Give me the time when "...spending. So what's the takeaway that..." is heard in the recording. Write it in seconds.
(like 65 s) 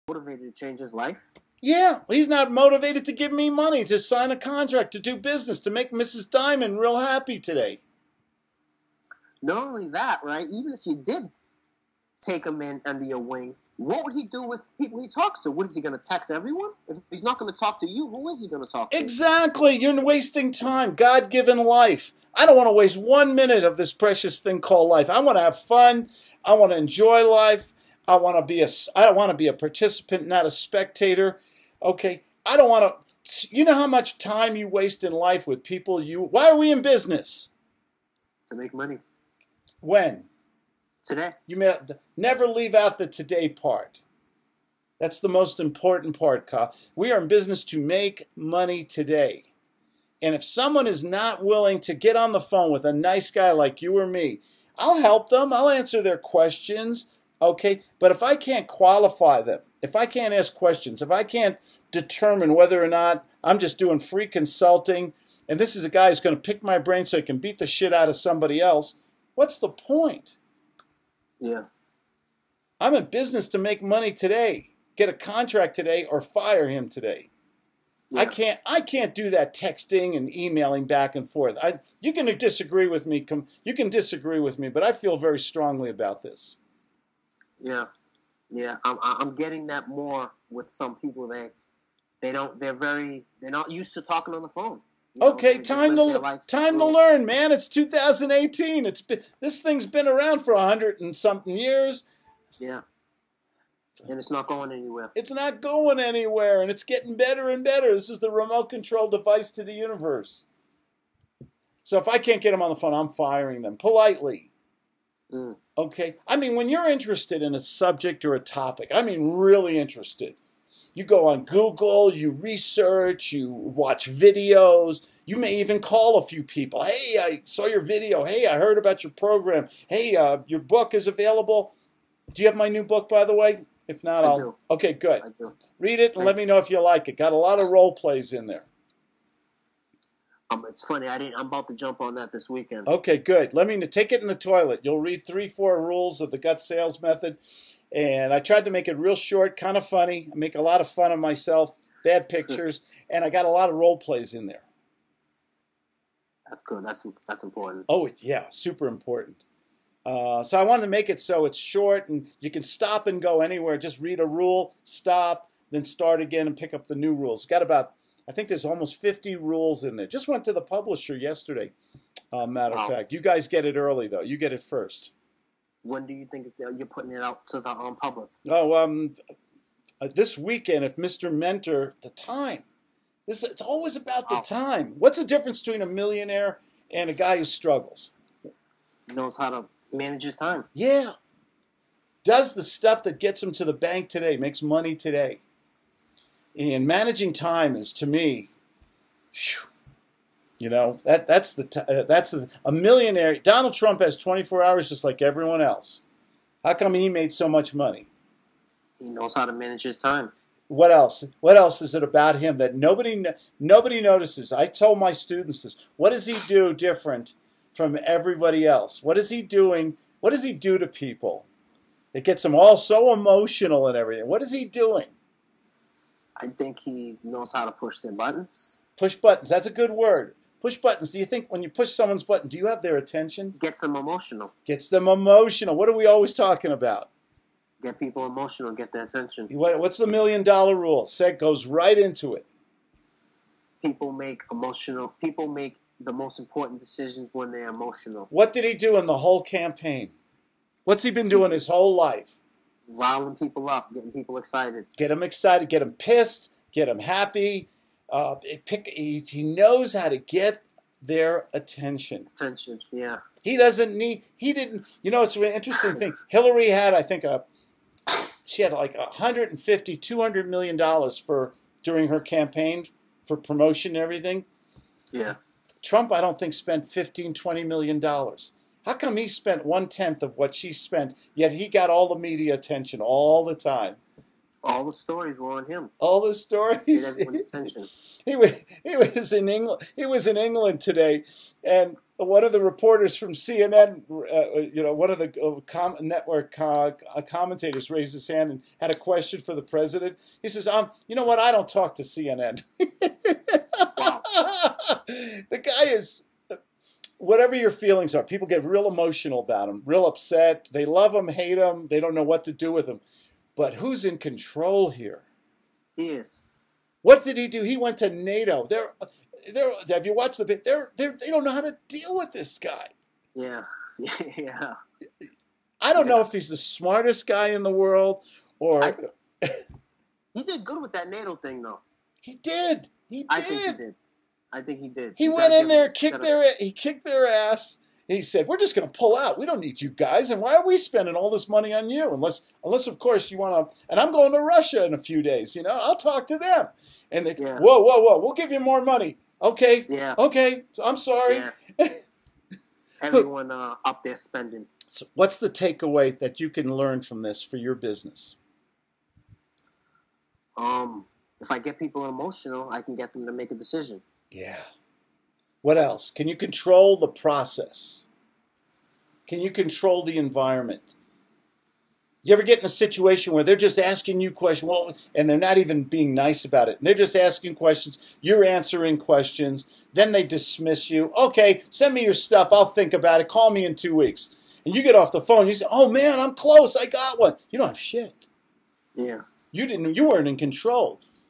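354 s.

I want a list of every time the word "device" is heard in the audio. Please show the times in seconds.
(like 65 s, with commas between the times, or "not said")
109 s.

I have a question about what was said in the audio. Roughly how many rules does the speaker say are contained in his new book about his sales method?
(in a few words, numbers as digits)
50.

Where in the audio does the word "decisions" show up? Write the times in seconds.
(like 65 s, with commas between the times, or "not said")
246 s, 363 s.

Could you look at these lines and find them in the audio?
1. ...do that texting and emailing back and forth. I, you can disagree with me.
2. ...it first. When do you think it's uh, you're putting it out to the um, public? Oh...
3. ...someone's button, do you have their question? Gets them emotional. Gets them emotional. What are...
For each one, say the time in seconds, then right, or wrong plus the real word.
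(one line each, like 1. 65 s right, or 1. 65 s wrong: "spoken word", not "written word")
1. 79 s right
2. 174 s right
3. 231 s wrong: "attention", not "question".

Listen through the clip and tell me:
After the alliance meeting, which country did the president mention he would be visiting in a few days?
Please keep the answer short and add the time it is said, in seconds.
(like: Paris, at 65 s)
Russia, at 344 s.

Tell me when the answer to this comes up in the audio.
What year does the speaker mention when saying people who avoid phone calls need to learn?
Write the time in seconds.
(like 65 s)
97 s.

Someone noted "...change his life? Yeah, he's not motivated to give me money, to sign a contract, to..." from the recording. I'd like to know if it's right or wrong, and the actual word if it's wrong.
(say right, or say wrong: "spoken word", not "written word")
right.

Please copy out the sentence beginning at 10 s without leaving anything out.
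Even if you did take him in under your wing, what would he do with people he talks to?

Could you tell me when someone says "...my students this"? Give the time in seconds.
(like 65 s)
214 s.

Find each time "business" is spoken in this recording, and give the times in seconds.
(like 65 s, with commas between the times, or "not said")
5 s, 36 s, 47 s, 73 s, 357 s.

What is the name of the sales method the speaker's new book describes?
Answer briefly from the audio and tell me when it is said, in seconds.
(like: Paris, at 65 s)
GUTS, at 146 s.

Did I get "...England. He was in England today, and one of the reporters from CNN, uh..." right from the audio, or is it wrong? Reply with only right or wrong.
right.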